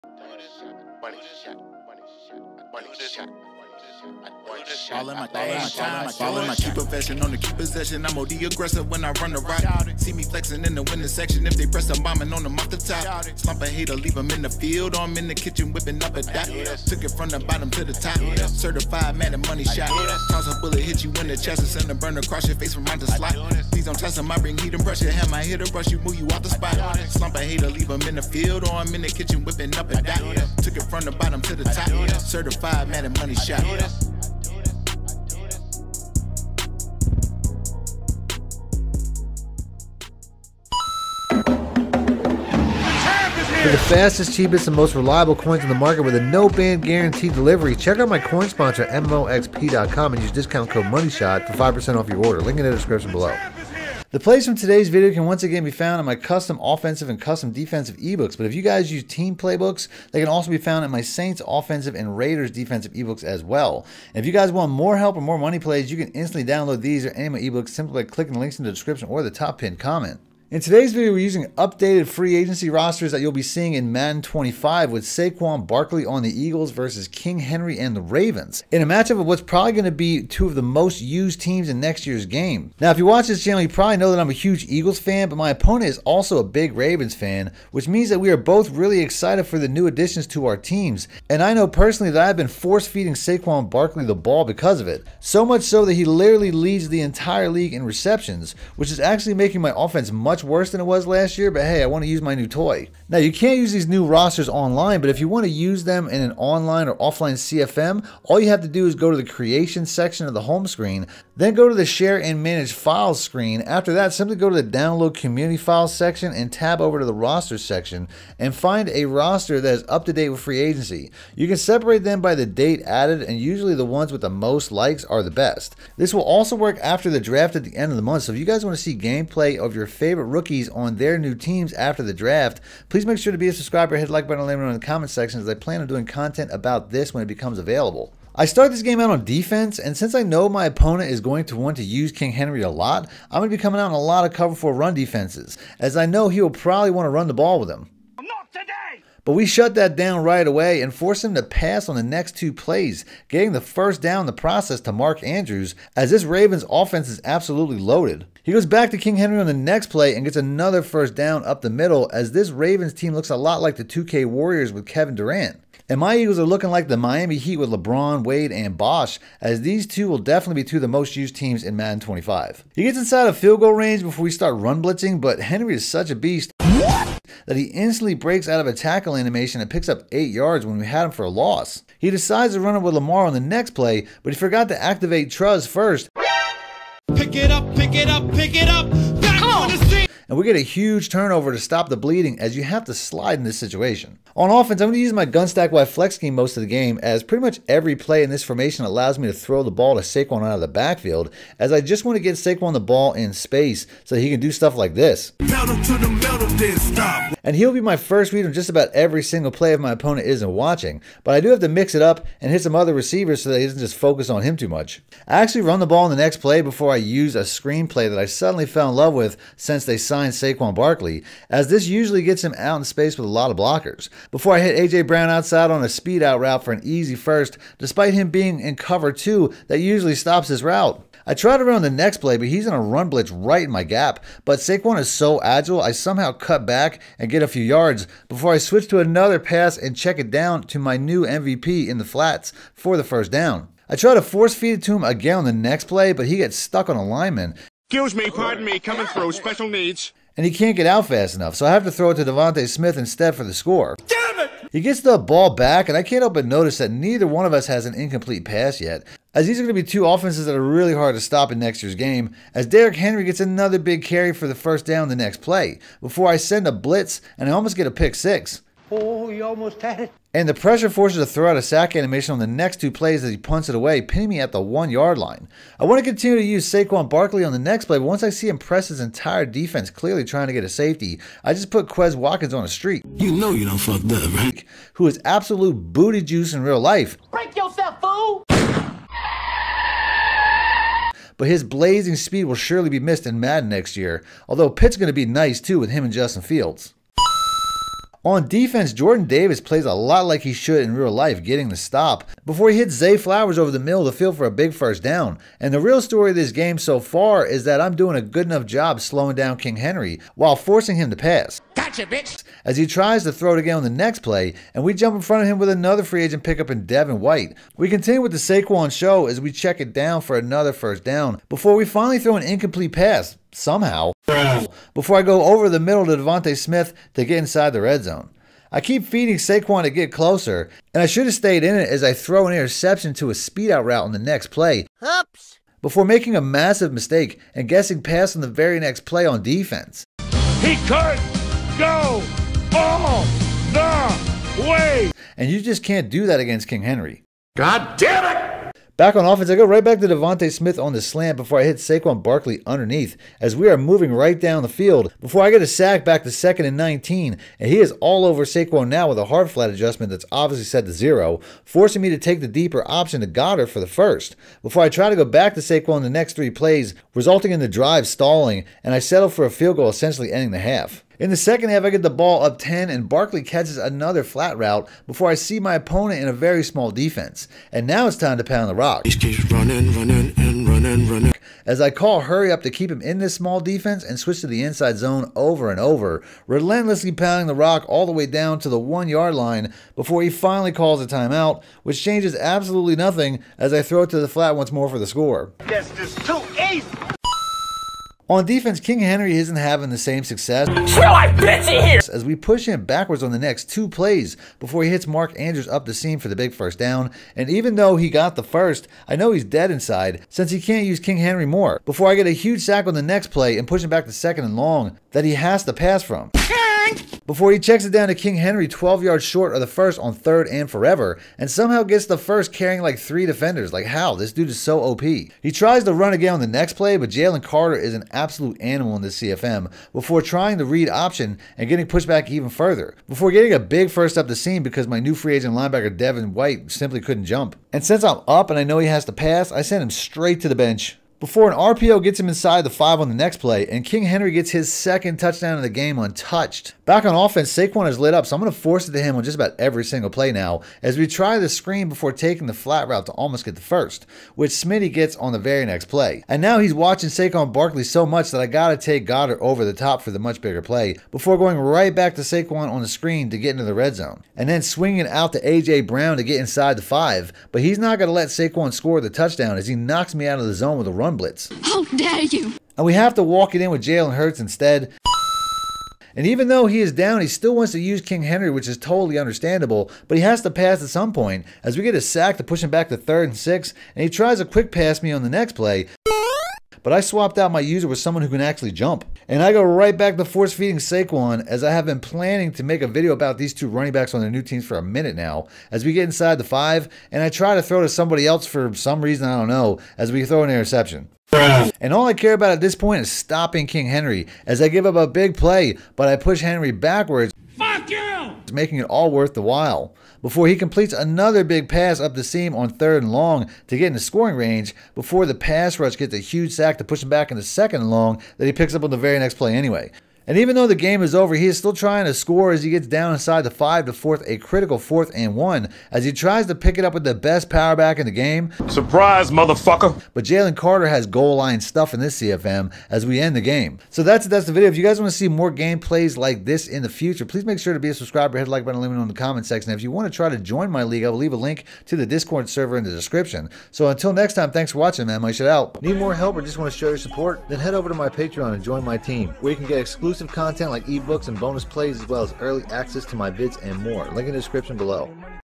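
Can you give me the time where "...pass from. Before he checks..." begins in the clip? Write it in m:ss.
6:55.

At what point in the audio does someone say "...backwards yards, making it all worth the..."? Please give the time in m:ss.
8:26.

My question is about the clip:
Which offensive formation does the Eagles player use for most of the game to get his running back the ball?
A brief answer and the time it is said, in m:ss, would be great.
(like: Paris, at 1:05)
gun stack wide flex, at 3:15.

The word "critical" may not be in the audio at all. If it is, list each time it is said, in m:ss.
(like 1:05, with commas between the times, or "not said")
8:44.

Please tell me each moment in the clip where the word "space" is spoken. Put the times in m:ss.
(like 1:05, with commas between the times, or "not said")
3:23, 3:42.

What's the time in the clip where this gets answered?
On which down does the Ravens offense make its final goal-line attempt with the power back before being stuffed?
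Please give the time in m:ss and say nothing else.
8:44.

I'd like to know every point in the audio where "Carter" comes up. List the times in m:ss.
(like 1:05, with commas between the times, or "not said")
7:07, 8:50.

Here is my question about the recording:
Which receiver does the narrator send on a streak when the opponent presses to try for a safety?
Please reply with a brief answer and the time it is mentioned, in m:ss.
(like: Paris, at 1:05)
Quez Watkins, at 4:41.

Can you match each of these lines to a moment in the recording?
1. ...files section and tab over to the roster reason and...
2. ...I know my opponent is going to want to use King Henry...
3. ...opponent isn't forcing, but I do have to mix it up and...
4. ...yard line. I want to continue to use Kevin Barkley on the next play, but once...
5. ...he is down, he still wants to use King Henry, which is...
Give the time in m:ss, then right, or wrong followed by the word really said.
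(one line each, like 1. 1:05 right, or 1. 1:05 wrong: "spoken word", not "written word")
1. 1:55 wrong: "section", not "reason"
2. 2:20 right
3. 3:29 wrong: "watching", not "forcing"
4. 4:34 wrong: "Saquon", not "Kevin"
5. 7:56 right.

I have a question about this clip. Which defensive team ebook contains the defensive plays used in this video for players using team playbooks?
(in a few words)
Raiders.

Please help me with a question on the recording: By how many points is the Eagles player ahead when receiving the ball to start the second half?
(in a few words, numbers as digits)
10.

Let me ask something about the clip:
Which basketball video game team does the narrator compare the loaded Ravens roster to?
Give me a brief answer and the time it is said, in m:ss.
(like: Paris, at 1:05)
Warriors, at 2:44.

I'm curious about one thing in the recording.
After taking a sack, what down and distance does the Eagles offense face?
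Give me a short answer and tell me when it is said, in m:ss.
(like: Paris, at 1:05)
second and 19, at 5:56.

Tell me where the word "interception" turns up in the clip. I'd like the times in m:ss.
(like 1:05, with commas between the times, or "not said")
5:32, 8:20.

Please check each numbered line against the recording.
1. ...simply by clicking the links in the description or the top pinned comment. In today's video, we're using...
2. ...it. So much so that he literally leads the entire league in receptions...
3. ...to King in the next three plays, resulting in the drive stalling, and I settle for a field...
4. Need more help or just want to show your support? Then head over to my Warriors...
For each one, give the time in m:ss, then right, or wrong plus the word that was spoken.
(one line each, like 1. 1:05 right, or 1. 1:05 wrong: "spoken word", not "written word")
1. 1:07 right
2. 1:34 right
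3. 6:05 wrong: "Saquon", not "King"
4. 9:05 wrong: "Patreon", not "Warriors".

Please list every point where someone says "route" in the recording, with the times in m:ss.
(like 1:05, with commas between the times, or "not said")
3:46, 3:50, 5:33, 6:14, 7:32.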